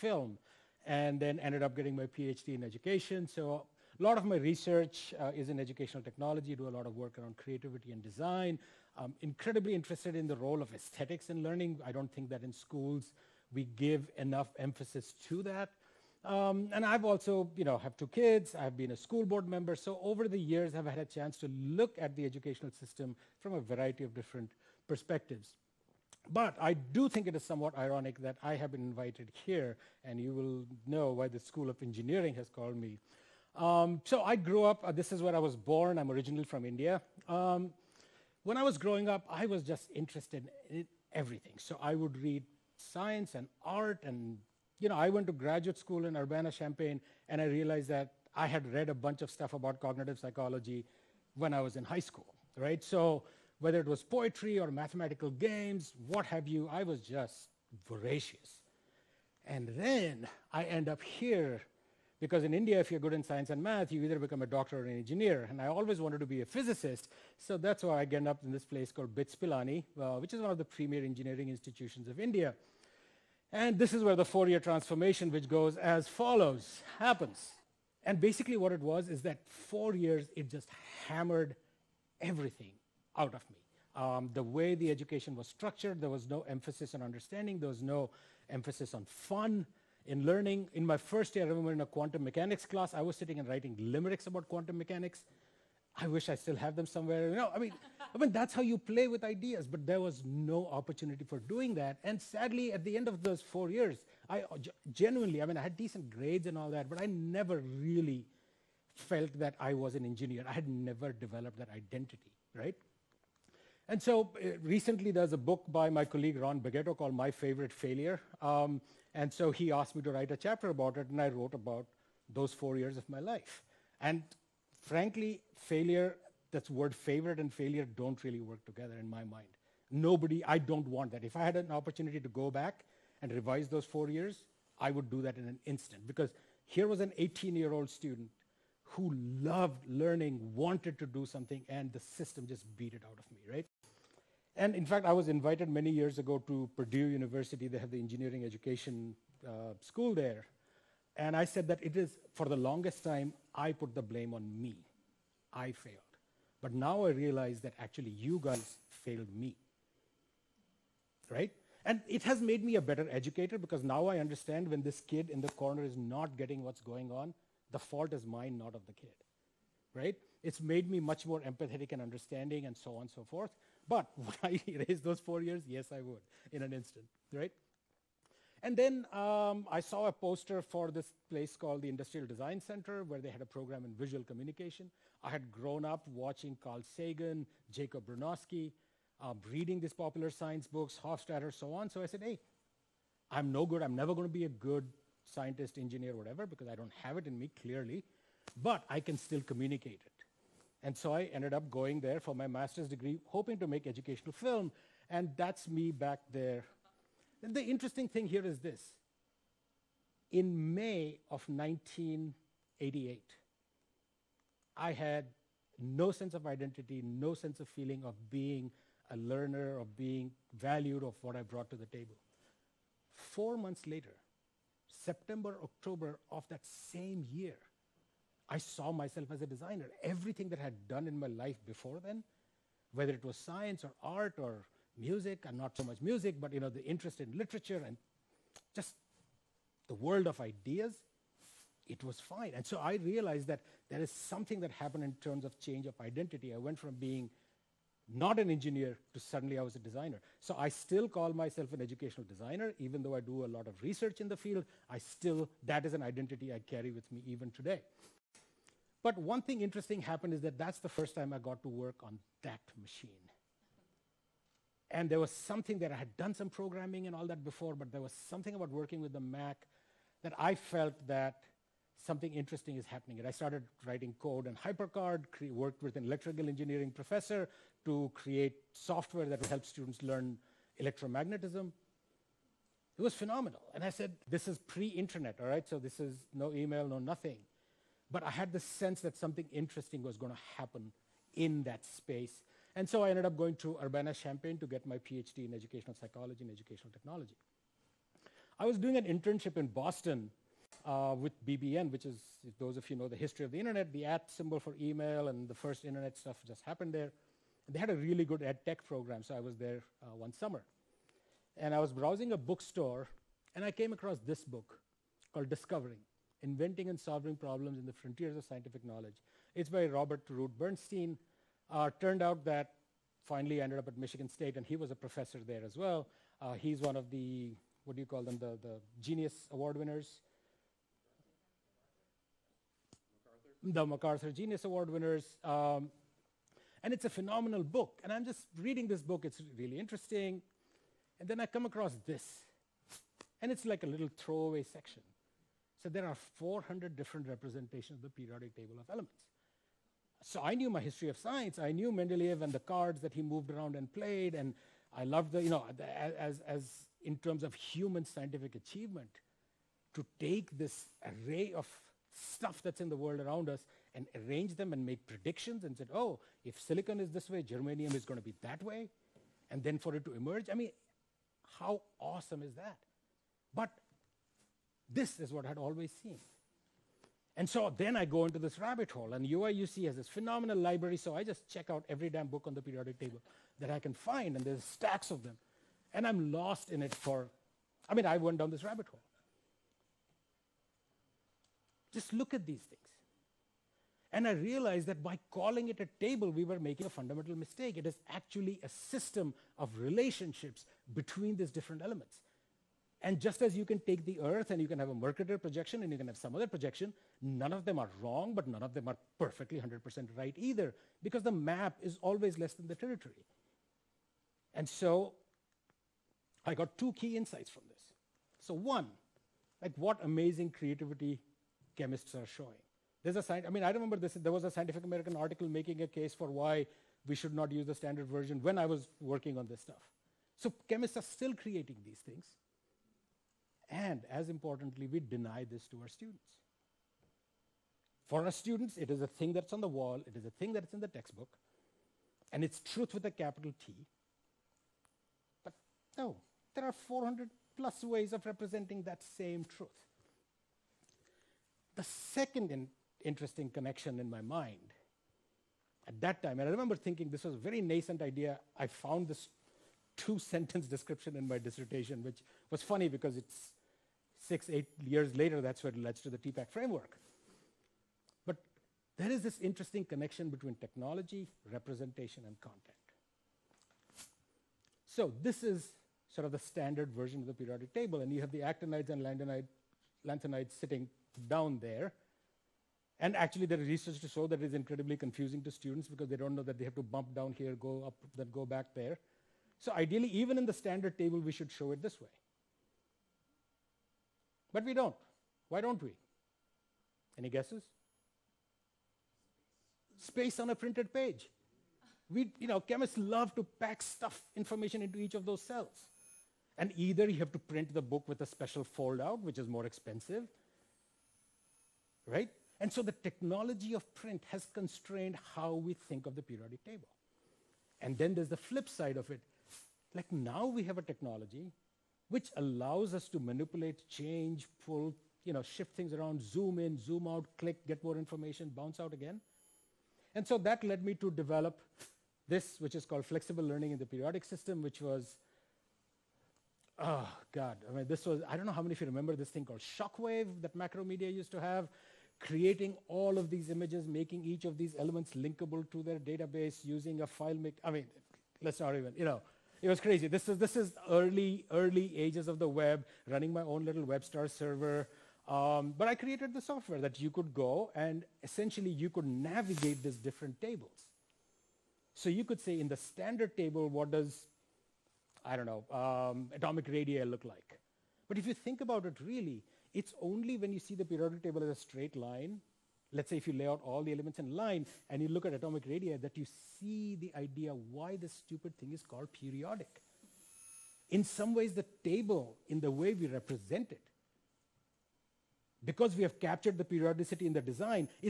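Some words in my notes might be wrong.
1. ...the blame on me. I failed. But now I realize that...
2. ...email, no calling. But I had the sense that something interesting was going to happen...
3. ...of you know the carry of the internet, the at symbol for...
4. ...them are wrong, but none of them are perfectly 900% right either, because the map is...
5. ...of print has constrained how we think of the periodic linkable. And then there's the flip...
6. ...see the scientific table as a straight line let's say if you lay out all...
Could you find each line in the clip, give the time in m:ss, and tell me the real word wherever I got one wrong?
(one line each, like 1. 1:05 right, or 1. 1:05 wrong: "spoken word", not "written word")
1. 2:33 right
2. 4:46 wrong: "nothing", not "calling"
3. 5:02 wrong: "history", not "carry"
4. 6:47 wrong: "100", not "900"
5. 8:33 wrong: "table", not "linkable"
6. 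9:30 wrong: "periodic", not "scientific".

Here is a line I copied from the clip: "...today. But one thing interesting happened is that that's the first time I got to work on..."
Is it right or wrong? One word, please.
right.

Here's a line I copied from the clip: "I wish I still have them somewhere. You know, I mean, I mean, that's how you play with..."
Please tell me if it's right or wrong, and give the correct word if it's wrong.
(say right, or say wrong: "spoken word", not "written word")
right.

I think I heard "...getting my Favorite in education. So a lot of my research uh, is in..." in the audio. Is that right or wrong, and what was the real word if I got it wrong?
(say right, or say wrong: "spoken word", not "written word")
wrong: "PhD", not "Favorite".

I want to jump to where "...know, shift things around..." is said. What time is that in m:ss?
8:45.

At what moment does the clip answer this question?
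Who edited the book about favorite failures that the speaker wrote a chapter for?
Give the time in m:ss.
1:56.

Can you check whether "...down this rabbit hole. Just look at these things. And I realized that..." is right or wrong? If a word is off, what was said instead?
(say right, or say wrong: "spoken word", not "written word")
right.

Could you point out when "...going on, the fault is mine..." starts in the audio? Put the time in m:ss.
2:46.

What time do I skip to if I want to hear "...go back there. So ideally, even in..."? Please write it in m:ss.
8:08.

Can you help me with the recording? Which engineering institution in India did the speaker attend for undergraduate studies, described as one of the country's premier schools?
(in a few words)
BITS Pilani.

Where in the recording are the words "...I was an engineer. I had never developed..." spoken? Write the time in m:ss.
1:49.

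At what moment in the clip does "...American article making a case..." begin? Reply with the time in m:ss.
7:04.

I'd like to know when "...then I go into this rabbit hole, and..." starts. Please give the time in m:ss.
6:17.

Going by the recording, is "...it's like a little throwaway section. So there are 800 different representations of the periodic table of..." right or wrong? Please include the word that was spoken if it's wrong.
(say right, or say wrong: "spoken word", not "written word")
wrong: "400", not "800".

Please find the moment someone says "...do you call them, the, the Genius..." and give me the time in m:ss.
5:27.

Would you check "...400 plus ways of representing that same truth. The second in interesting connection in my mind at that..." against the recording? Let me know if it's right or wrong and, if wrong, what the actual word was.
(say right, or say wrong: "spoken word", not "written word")
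right.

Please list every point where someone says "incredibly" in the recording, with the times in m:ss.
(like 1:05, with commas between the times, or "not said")
0:09, 8:04.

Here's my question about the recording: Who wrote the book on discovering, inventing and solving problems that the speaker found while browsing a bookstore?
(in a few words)
Robert Root Bernstein.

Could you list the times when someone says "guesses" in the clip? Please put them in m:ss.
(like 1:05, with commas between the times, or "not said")
8:17.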